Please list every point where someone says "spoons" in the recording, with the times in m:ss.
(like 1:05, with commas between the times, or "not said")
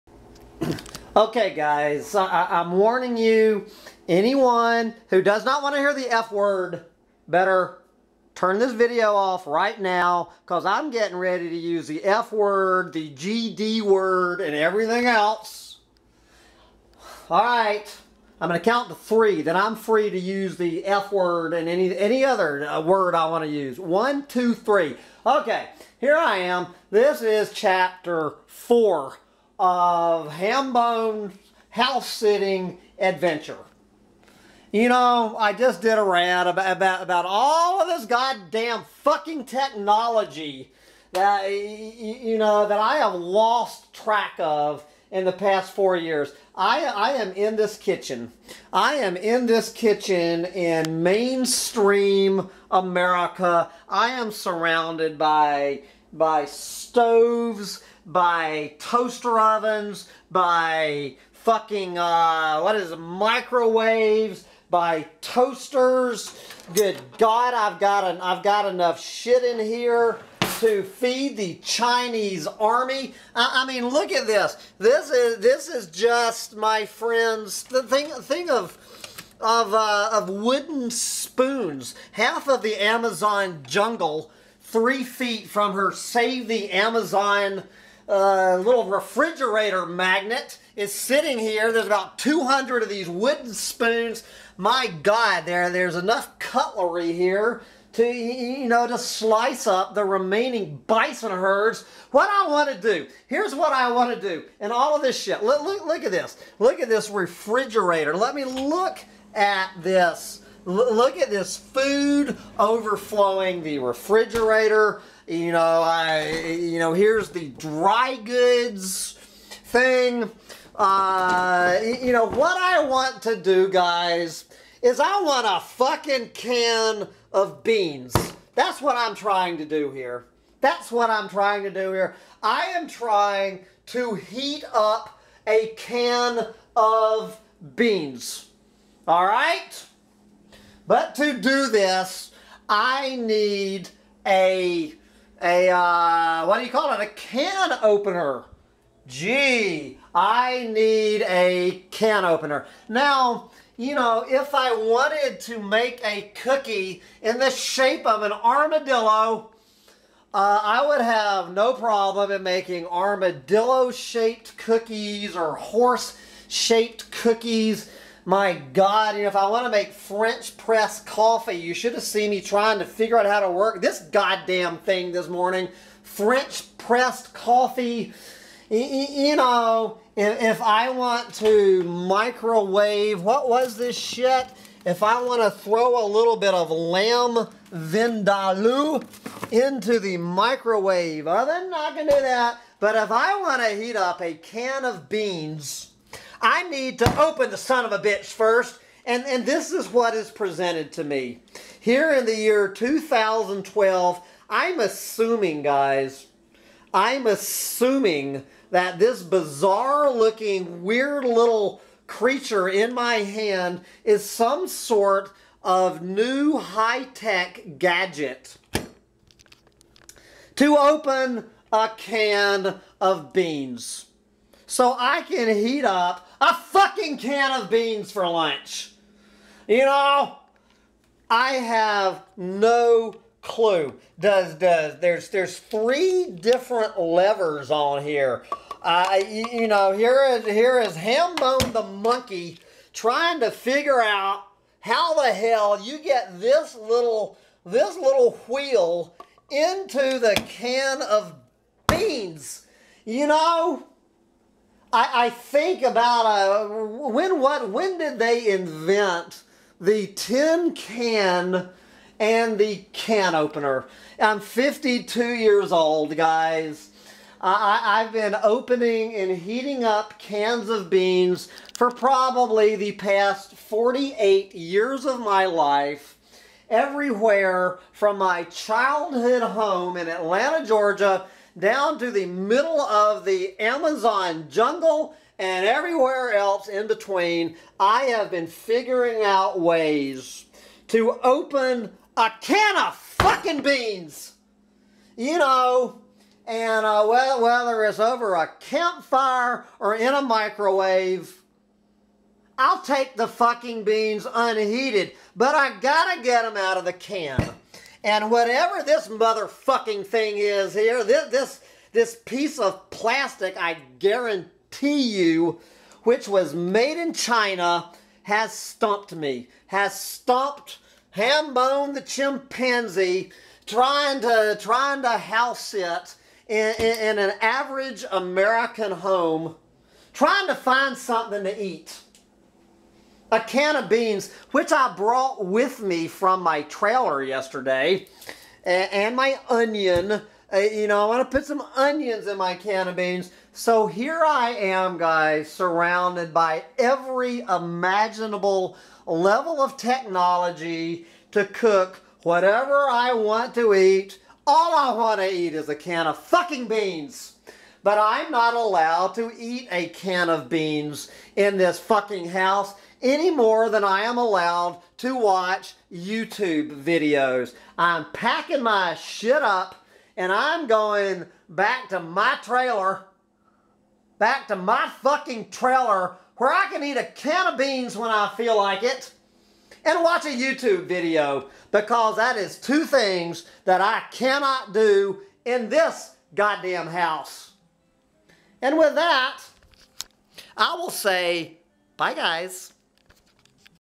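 1:20, 1:33.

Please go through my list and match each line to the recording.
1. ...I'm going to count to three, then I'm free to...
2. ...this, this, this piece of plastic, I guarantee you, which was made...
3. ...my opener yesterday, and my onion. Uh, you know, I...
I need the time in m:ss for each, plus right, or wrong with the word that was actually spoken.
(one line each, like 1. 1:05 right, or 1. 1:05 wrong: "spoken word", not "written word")
1. 0:18 right
2. 5:11 right
3. 5:36 wrong: "trailer", not "opener".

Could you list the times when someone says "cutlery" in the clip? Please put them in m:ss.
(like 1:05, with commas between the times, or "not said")
1:36.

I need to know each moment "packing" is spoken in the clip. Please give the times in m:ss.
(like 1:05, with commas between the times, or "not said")
6:08.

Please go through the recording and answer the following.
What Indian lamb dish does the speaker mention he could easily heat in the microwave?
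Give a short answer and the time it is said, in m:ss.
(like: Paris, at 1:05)
Lamb vindaloo, at 3:06.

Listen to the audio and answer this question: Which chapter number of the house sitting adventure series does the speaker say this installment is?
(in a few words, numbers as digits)
4.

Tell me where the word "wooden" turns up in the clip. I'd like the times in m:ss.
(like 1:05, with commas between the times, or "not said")
1:20, 1:33.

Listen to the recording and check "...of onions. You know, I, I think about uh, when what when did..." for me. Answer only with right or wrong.
wrong.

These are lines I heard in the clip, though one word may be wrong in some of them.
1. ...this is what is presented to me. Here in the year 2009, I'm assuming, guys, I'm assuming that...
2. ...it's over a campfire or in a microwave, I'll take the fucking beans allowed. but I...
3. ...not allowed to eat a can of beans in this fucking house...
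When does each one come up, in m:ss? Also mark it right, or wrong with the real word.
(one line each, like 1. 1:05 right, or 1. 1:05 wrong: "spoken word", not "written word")
1. 3:19 wrong: "2012", not "2009"
2. 4:57 wrong: "unheated", not "allowed"
3. 5:58 right.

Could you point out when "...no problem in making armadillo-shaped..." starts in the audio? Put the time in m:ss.
2:41.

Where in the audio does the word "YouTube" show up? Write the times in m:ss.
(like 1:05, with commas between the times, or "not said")
6:05, 6:20.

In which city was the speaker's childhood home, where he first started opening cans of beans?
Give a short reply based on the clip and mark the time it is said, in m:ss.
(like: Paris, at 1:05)
Atlanta, Georgia, at 4:40.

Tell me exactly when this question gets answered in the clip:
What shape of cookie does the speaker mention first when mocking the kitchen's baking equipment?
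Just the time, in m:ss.
2:38.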